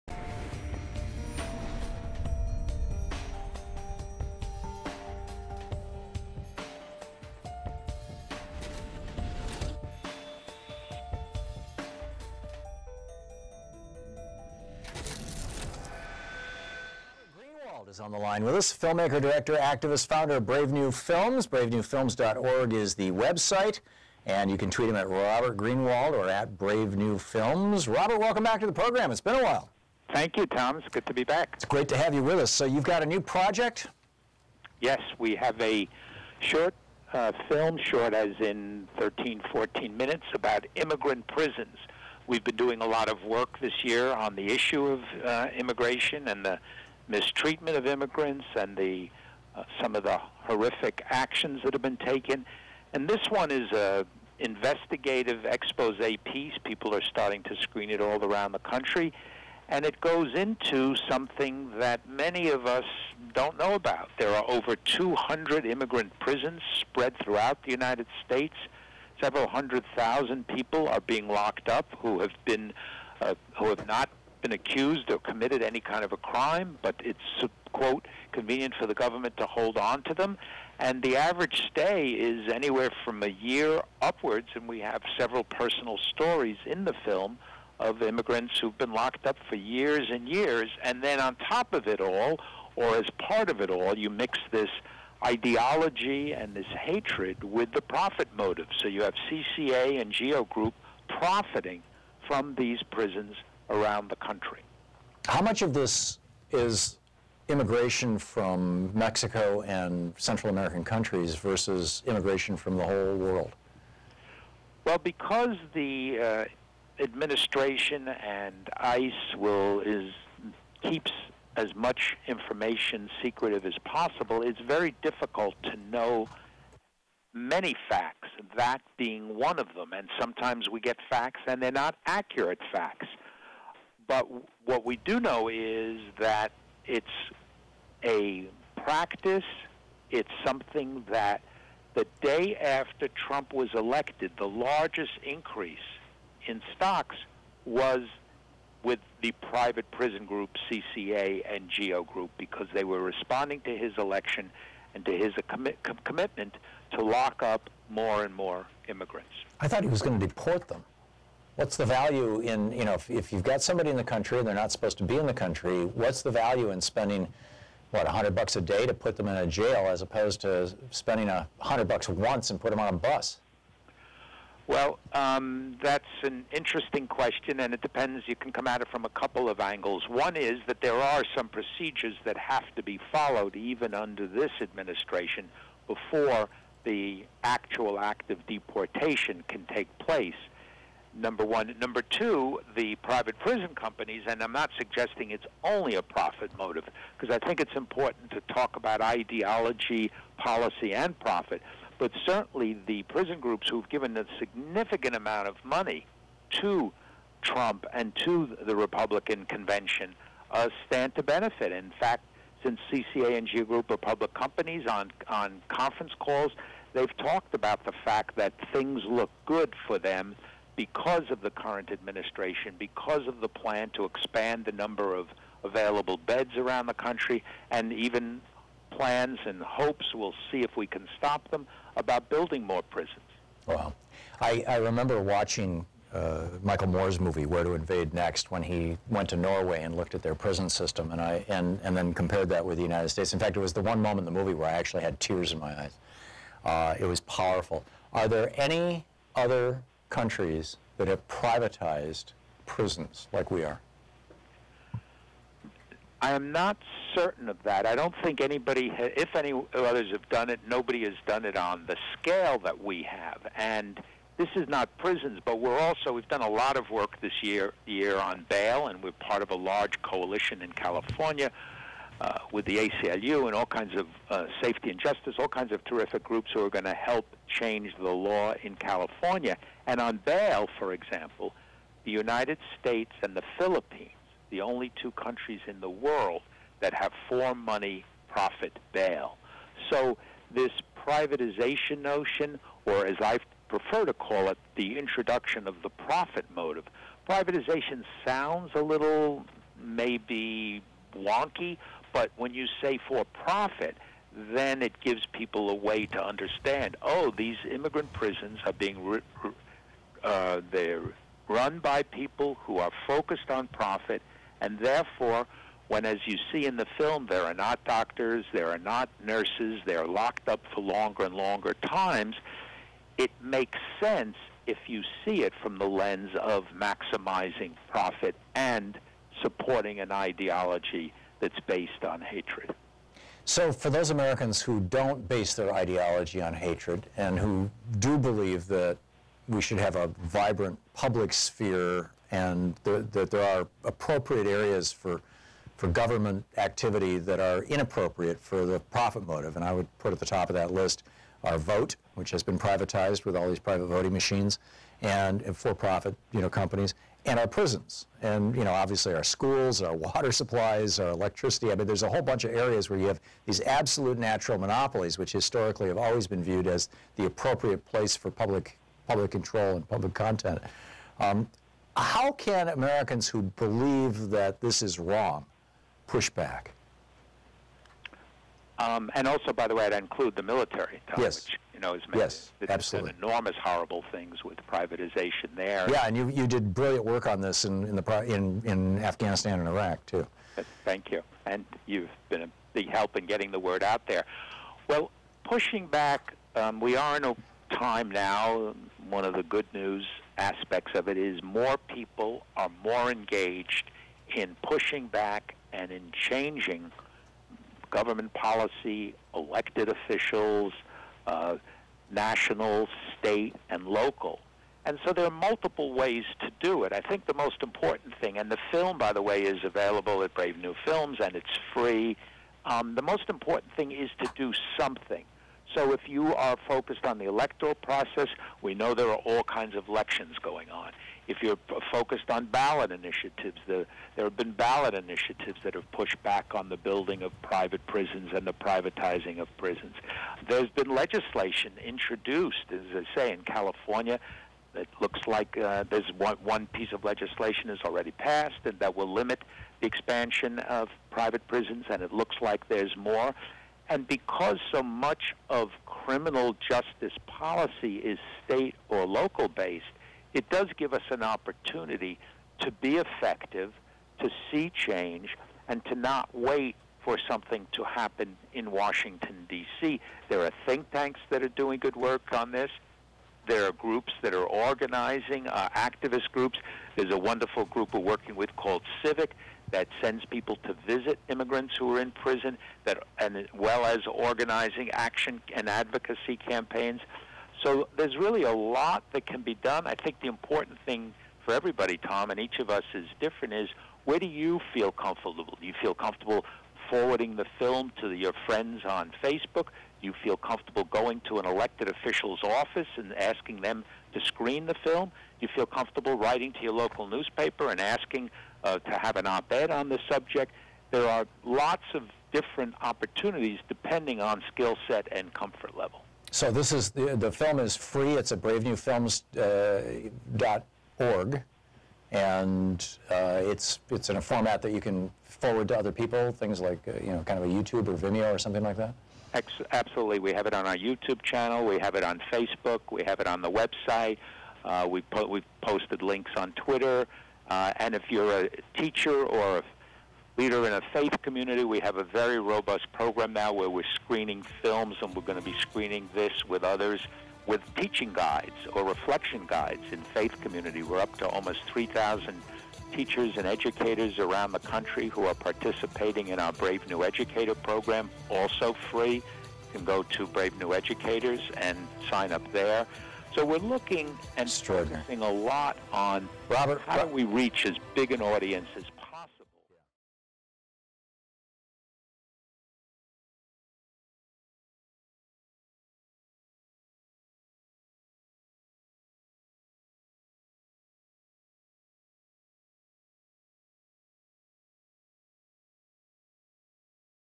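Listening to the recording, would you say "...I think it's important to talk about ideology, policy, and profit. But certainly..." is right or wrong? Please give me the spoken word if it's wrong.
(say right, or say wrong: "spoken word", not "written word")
right.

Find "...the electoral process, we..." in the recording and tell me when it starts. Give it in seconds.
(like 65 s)
427 s.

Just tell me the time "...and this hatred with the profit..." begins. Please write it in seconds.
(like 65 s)
96 s.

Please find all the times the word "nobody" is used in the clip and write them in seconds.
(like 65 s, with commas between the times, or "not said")
260 s.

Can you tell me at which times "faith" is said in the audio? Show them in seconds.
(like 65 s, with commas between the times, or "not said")
540 s, 550 s.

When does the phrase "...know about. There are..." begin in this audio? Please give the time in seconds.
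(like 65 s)
63 s.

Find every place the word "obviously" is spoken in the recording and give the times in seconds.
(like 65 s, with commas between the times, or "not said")
358 s.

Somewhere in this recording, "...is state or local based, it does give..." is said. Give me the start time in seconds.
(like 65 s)
457 s.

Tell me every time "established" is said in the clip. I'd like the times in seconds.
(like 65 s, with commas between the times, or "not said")
not said.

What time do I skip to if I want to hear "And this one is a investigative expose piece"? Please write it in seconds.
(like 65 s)
52 s.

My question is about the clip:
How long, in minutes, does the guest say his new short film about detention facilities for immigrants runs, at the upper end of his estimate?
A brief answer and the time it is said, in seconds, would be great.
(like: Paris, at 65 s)
14, at 39 s.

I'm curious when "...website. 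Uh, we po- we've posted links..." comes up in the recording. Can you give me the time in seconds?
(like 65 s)
533 s.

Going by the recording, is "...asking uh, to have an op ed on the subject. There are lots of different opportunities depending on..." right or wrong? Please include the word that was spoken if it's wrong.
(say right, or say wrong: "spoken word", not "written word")
right.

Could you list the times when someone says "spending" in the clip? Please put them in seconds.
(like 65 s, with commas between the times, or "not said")
166 s, 170 s.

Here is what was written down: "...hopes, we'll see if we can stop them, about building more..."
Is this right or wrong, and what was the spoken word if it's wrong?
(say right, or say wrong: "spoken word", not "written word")
right.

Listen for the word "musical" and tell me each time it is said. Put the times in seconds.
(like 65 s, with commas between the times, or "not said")
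not said.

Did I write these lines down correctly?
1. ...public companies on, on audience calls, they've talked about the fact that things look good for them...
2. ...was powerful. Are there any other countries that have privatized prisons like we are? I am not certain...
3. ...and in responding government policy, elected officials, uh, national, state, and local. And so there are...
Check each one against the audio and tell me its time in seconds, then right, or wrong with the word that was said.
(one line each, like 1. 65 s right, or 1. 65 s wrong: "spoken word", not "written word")
1. 213 s wrong: "conference", not "audience"
2. 247 s right
3. 405 s wrong: "changing", not "responding".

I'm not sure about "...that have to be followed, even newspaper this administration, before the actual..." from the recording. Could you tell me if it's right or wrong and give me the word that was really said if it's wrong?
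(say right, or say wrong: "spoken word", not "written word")
wrong: "under", not "newspaper".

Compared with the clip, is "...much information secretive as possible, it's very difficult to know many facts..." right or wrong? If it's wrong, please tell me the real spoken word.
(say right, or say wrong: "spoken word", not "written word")
right.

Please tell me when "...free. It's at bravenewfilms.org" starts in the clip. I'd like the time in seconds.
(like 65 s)
517 s.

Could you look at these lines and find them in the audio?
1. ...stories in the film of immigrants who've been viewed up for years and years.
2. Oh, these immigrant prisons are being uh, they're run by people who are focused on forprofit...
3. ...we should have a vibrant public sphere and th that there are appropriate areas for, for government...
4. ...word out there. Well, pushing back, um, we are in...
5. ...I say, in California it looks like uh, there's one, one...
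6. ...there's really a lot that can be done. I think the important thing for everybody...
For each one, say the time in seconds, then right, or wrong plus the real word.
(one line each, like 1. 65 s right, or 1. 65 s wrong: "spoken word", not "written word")
1. 85 s wrong: "locked", not "viewed"
2. 307 s wrong: "profit", not "forprofit"
3. 339 s right
4. 393 s right
5. 443 s right
6. 487 s right.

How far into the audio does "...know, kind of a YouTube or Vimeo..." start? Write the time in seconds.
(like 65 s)
527 s.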